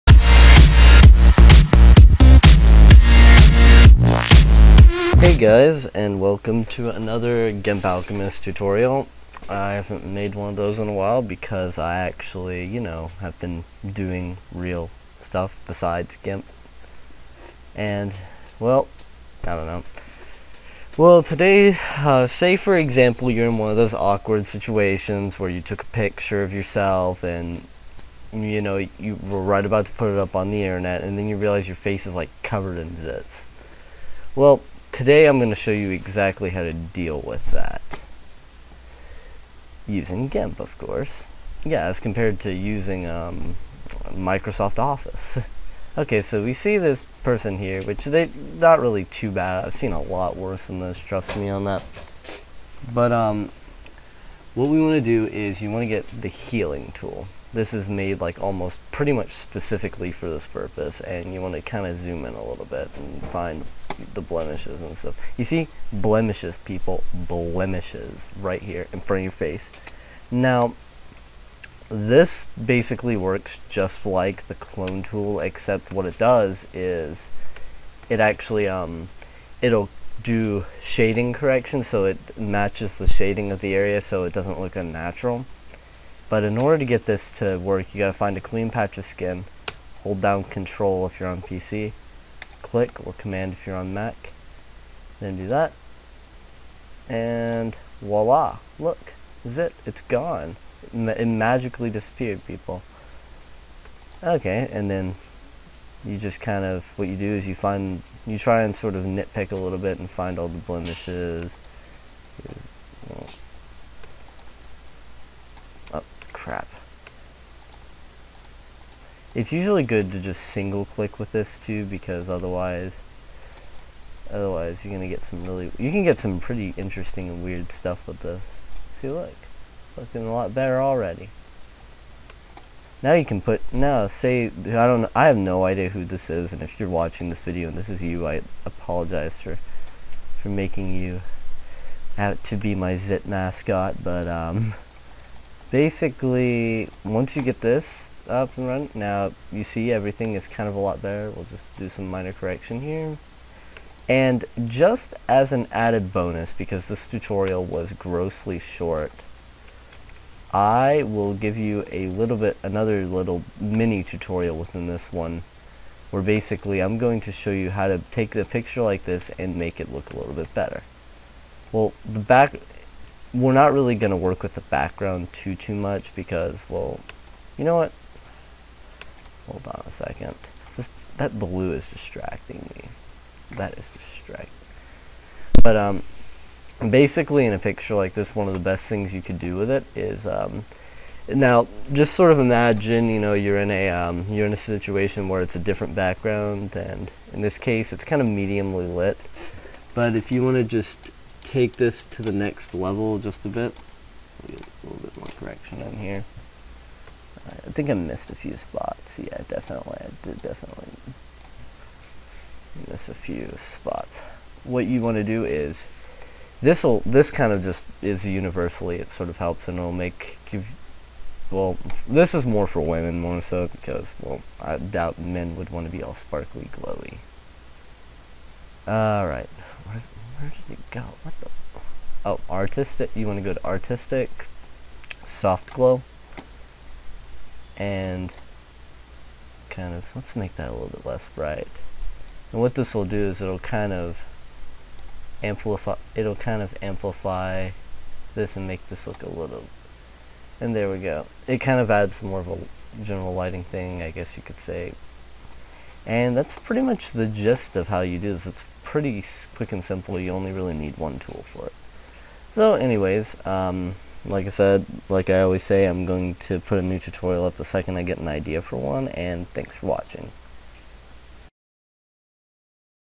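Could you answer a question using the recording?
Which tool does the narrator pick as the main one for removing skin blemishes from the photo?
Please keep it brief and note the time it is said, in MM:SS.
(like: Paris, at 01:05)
healing tool, at 00:56.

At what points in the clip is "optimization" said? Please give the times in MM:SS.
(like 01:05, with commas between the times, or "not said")
not said.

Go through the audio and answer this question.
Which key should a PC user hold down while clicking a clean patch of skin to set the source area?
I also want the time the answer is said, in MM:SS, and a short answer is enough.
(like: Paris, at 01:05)
Control, at 01:30.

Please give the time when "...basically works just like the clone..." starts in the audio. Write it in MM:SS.
01:12.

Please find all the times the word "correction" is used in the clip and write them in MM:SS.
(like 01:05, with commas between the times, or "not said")
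01:21, 02:32, 03:25.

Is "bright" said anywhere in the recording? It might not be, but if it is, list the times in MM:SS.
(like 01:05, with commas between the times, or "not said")
04:01.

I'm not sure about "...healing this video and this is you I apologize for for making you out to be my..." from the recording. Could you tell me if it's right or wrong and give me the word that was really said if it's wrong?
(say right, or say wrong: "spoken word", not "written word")
wrong: "watching", not "healing".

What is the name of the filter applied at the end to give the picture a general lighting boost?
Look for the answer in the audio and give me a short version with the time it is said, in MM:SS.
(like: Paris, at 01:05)
Soft glow, at 03:55.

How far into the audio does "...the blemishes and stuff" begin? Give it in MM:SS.
01:04.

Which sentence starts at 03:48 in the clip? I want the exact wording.
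All right, where, where did it go?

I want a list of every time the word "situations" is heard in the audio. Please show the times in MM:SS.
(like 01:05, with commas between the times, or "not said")
00:24, 03:14.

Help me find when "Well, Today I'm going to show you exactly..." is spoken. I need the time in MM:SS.
00:34.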